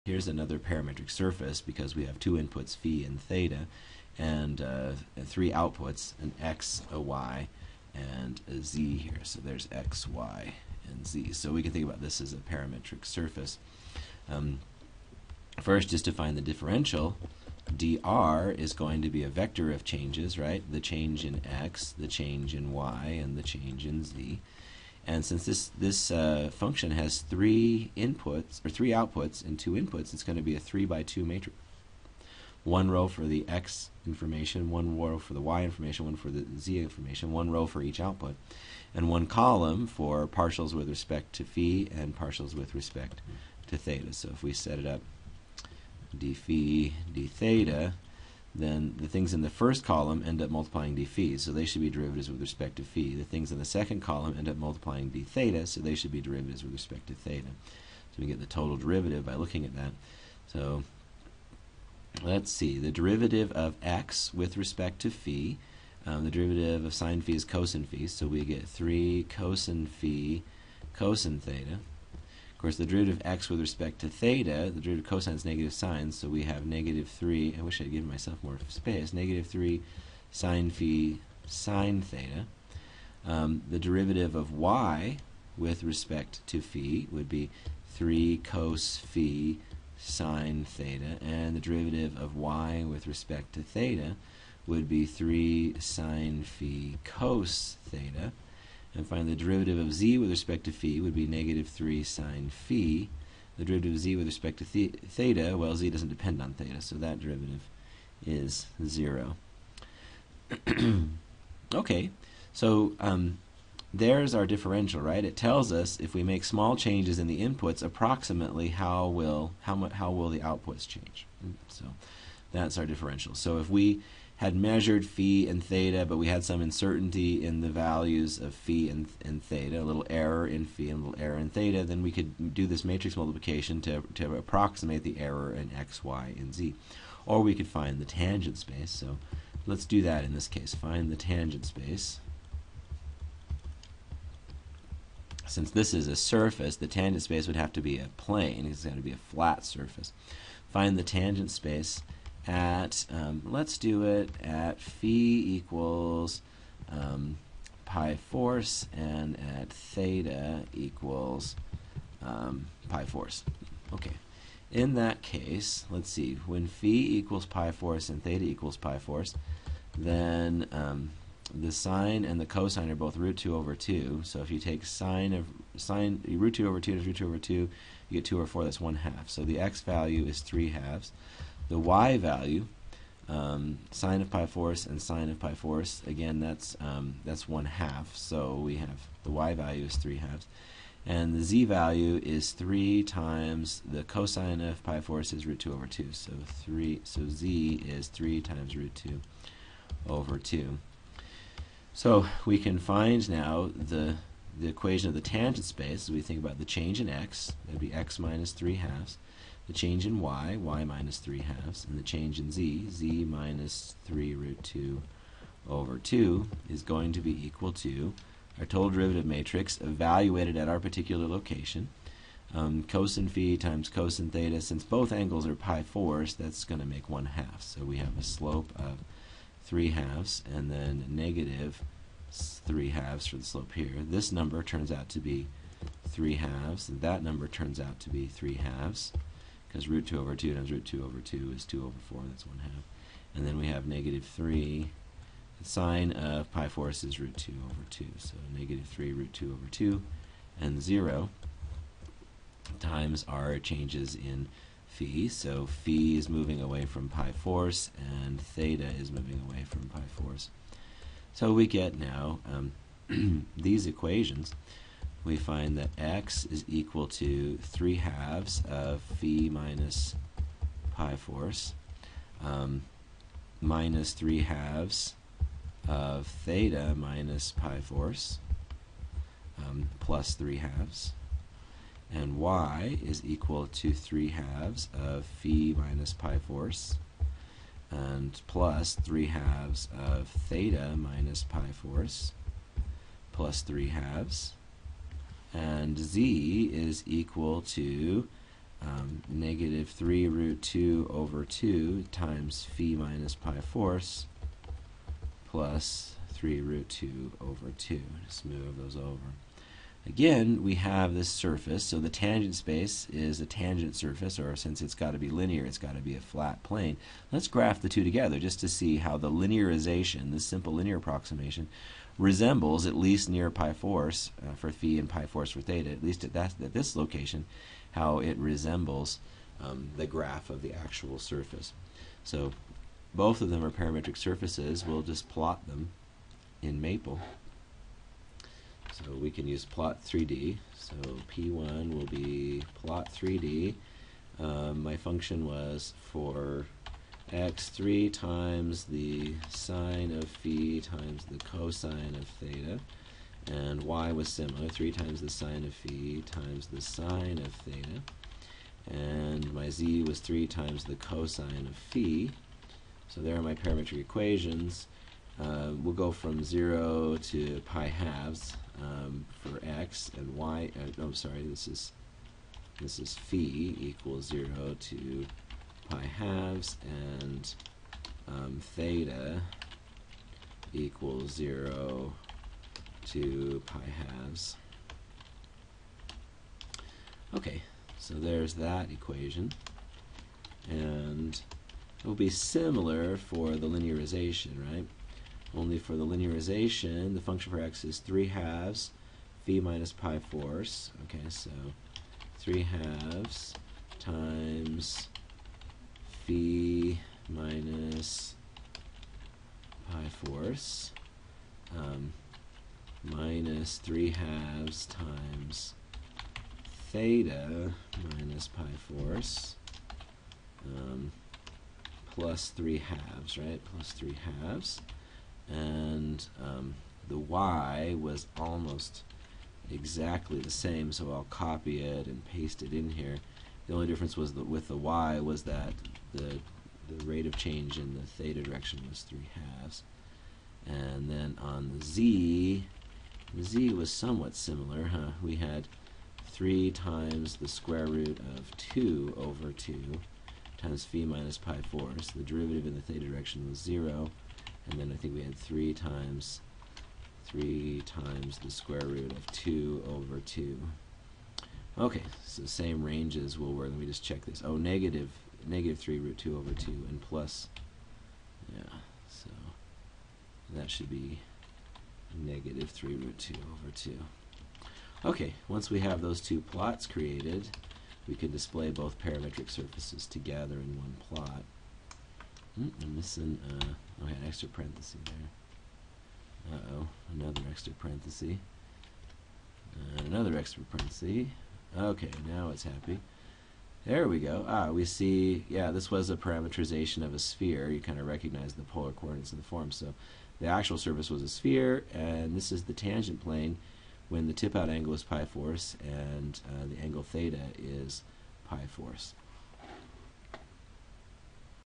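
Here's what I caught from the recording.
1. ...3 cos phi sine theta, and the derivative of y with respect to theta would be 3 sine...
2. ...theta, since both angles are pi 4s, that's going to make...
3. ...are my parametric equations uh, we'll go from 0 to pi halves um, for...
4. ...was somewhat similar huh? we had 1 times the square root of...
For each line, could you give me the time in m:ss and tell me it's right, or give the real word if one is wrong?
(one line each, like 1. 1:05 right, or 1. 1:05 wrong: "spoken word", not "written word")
1. 1:27 right
2. 3:44 right
3. 6:03 right
4. 7:23 wrong: "3", not "1".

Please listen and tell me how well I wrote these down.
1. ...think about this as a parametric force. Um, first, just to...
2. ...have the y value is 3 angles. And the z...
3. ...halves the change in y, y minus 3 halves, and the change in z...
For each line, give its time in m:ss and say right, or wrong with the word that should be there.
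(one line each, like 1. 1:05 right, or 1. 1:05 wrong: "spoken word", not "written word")
1. 0:11 wrong: "surface", not "force"
2. 3:08 wrong: "halves", not "angles"
3. 3:28 right.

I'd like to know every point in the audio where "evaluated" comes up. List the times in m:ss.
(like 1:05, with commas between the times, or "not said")
3:39.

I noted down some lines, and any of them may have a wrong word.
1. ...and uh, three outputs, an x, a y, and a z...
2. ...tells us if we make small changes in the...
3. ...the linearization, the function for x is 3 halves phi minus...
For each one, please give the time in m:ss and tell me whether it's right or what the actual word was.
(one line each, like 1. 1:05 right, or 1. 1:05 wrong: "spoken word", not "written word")
1. 0:04 right
2. 1:55 right
3. 6:35 right.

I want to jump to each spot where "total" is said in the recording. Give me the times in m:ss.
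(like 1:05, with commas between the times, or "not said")
0:58, 3:38.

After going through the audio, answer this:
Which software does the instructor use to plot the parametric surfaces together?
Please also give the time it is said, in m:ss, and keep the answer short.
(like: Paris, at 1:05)
Maple, at 5:36.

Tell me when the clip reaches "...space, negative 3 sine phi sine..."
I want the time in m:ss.
1:18.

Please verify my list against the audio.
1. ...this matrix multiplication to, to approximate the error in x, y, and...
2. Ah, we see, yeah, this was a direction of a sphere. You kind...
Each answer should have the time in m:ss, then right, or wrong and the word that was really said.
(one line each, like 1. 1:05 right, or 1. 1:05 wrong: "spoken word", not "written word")
1. 2:12 right
2. 8:14 wrong: "parameterization", not "direction".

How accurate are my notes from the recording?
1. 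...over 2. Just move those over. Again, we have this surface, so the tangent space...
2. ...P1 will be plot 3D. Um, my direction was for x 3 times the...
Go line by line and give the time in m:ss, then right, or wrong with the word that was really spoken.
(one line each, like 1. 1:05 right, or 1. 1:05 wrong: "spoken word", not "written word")
1. 5:07 right
2. 5:41 wrong: "function", not "direction".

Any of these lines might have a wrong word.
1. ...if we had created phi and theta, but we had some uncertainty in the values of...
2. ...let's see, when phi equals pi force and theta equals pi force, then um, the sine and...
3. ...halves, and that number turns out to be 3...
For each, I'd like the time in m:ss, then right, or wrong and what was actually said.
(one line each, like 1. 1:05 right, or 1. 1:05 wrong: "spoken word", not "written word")
1. 2:03 wrong: "measured", not "created"
2. 2:45 right
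3. 3:56 right.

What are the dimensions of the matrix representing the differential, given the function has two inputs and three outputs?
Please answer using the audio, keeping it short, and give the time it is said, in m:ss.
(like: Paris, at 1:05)
3 by 2, at 0:30.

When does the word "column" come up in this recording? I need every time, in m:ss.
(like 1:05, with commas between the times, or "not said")
0:39, 0:49, 0:54.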